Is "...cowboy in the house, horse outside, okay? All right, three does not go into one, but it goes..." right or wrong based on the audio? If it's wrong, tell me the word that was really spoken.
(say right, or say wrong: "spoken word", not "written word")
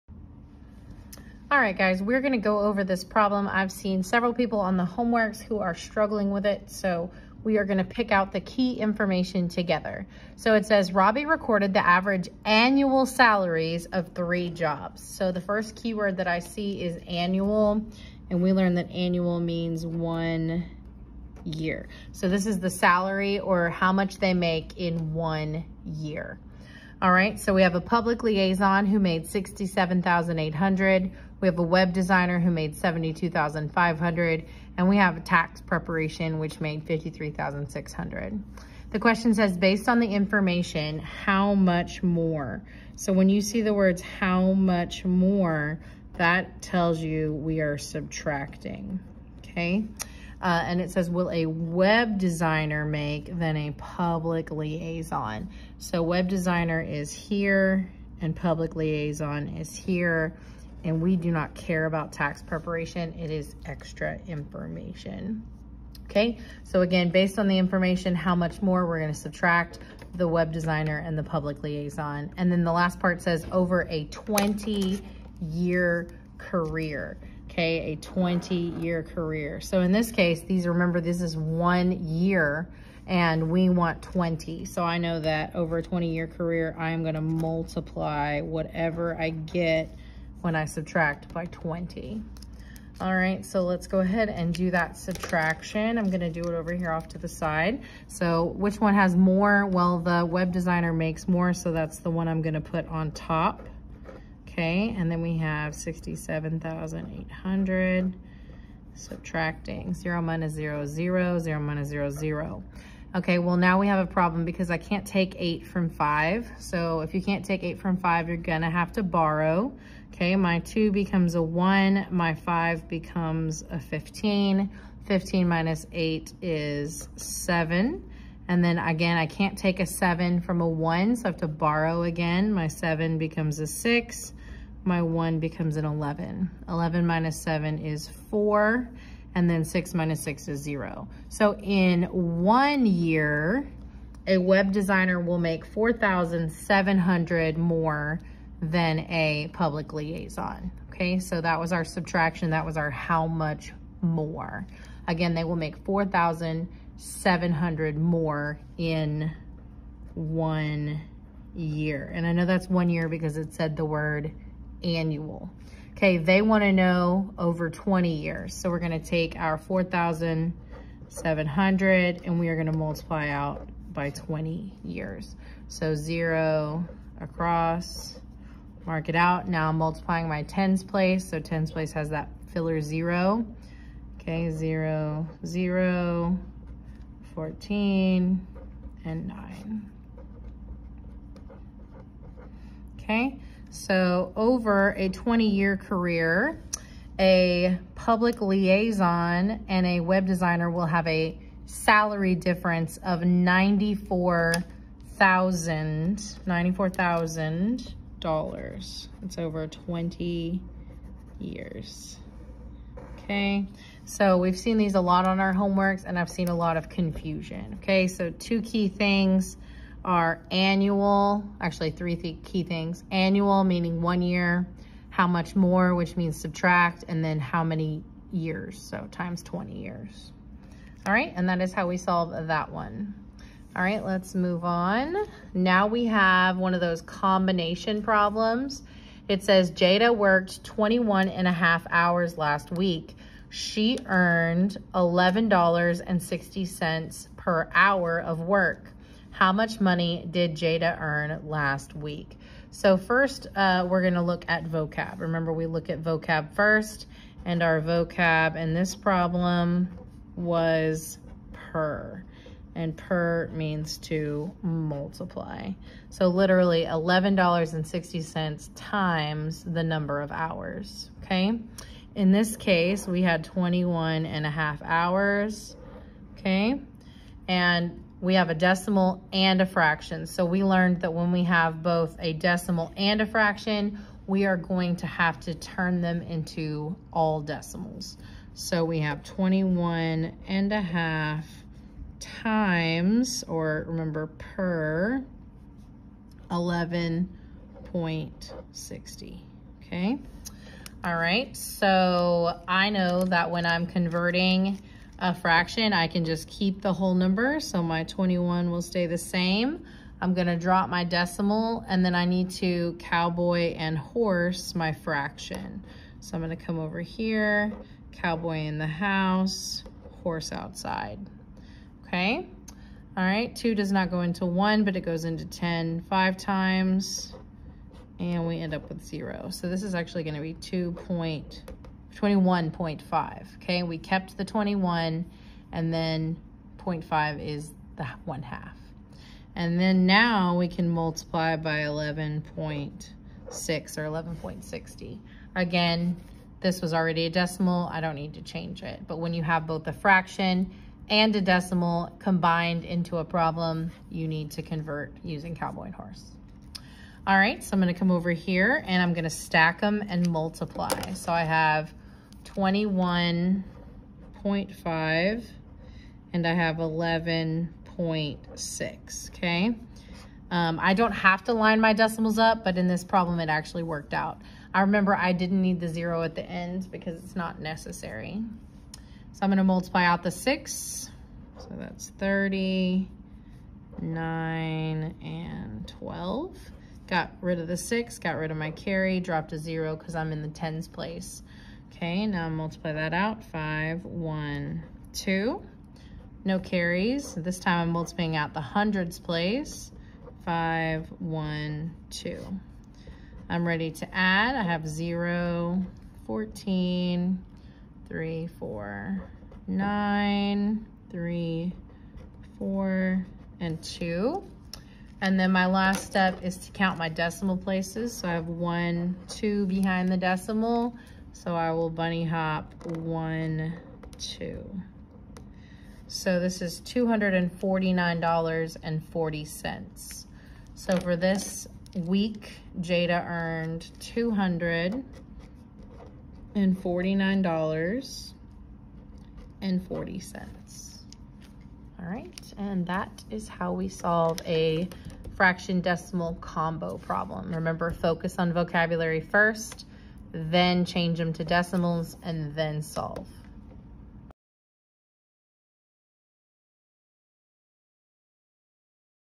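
wrong: "two", not "three".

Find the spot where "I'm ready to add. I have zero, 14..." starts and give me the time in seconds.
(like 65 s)
403 s.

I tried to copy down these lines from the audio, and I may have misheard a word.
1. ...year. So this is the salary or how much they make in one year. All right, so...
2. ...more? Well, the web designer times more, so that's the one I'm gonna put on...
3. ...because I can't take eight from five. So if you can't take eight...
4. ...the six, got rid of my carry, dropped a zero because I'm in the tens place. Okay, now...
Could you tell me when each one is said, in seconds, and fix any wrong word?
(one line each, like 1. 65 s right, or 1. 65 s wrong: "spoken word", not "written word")
1. 21 s right
2. 99 s wrong: "makes", not "times"
3. 114 s right
4. 387 s right.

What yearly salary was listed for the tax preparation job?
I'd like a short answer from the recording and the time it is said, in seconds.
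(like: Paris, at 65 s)
53,600, at 36 s.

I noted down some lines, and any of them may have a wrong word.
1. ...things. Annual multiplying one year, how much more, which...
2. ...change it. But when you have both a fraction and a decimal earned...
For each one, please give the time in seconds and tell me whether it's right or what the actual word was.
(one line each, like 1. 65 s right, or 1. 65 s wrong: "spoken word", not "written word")
1. 222 s wrong: "meaning", not "multiplying"
2. 348 s wrong: "combined", not "earned".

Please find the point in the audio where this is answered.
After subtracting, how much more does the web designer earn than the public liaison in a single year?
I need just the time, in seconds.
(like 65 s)
145 s.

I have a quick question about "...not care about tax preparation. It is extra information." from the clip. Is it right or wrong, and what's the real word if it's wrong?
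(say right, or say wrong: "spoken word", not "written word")
right.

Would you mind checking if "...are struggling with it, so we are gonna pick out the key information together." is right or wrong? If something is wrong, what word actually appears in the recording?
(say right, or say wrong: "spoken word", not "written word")
right.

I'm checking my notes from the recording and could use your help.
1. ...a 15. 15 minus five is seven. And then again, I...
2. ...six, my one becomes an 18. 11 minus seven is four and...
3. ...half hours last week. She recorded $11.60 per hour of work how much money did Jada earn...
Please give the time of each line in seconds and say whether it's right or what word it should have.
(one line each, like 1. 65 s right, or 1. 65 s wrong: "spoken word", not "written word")
1. 123 s wrong: "eight", not "five"
2. 133 s wrong: "11", not "18"
3. 241 s wrong: "earned", not "recorded".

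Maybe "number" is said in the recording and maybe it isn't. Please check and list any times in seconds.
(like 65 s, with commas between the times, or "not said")
269 s, 307 s.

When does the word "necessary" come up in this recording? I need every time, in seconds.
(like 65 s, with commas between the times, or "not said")
377 s.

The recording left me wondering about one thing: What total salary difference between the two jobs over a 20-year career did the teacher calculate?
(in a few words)
$94,000.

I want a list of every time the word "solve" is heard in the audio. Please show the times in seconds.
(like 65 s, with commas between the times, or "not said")
231 s, 443 s, 452 s.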